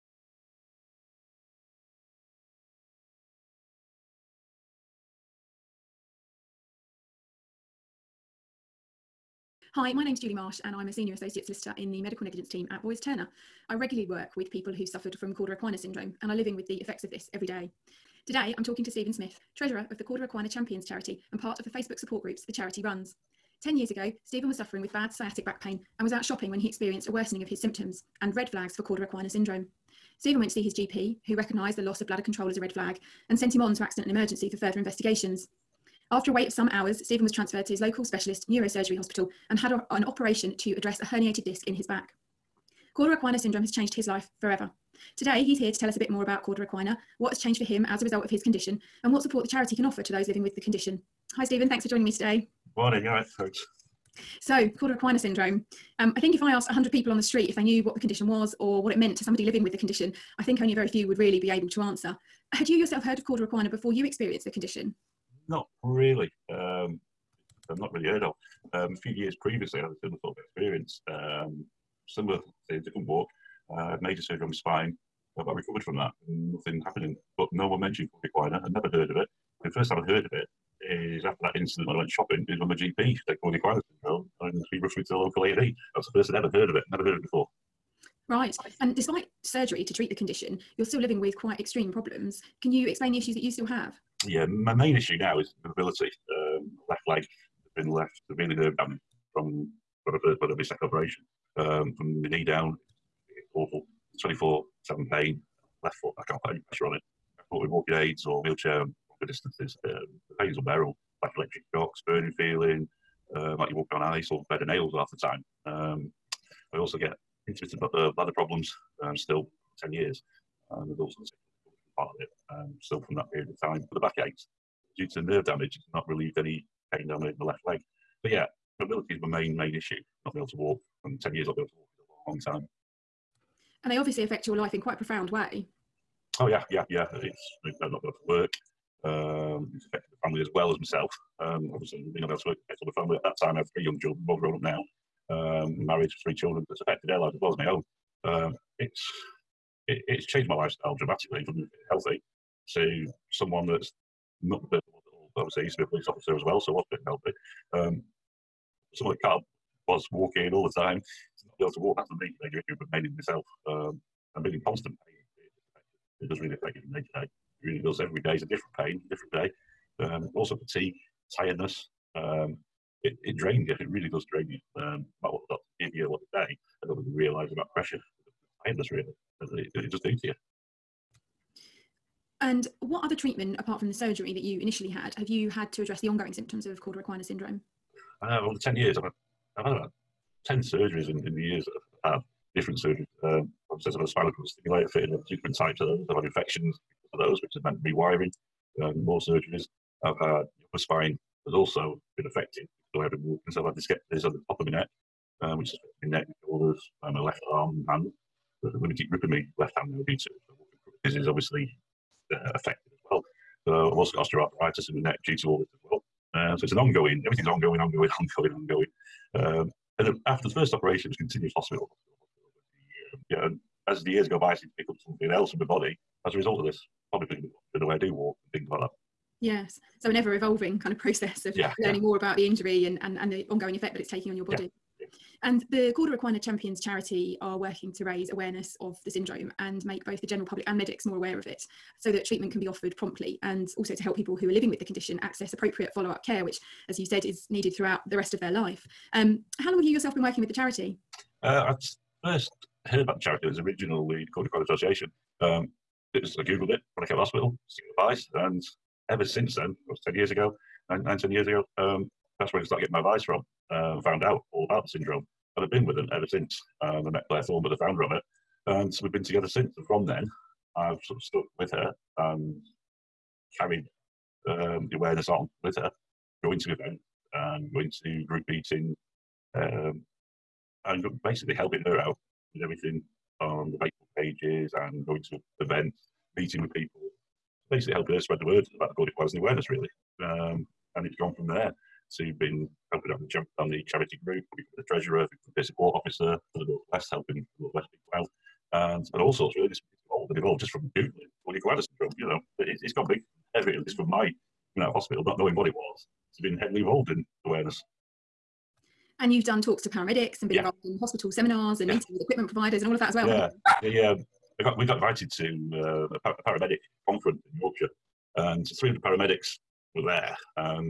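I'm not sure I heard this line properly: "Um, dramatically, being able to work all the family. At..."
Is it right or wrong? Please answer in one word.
wrong.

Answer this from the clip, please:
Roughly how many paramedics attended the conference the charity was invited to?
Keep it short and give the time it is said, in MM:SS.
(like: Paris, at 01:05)
300, at 05:18.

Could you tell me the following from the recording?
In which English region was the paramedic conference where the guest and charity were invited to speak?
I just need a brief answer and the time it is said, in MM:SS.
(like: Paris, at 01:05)
Yorkshire, at 05:17.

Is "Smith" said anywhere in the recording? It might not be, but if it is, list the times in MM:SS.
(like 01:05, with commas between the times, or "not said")
00:19.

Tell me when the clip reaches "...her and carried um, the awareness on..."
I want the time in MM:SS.
04:31.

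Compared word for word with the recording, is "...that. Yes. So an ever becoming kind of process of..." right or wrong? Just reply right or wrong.
wrong.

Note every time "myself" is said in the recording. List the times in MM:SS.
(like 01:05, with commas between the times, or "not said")
02:20, 02:43.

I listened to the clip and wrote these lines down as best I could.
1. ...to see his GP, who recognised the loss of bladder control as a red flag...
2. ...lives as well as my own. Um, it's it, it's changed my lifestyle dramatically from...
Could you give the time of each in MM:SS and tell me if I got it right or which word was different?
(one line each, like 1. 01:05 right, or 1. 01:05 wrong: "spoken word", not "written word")
1. 00:30 right
2. 02:27 right.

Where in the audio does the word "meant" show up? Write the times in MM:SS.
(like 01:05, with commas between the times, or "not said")
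00:58, 03:17.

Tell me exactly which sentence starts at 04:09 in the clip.
Um, how long have you yourself been working with the charity?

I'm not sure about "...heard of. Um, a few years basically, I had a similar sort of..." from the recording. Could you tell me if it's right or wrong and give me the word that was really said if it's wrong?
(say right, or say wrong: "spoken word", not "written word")
wrong: "previously", not "basically".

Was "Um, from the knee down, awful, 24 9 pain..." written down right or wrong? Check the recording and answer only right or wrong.
wrong.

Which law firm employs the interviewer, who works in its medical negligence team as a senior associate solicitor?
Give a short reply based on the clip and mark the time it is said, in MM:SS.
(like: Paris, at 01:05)
Boyes Turner, at 00:12.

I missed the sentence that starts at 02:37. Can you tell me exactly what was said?
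Um, someone that can't was walking all the time, not be able to walk.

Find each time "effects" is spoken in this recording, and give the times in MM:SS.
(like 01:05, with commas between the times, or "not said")
00:16, 03:53.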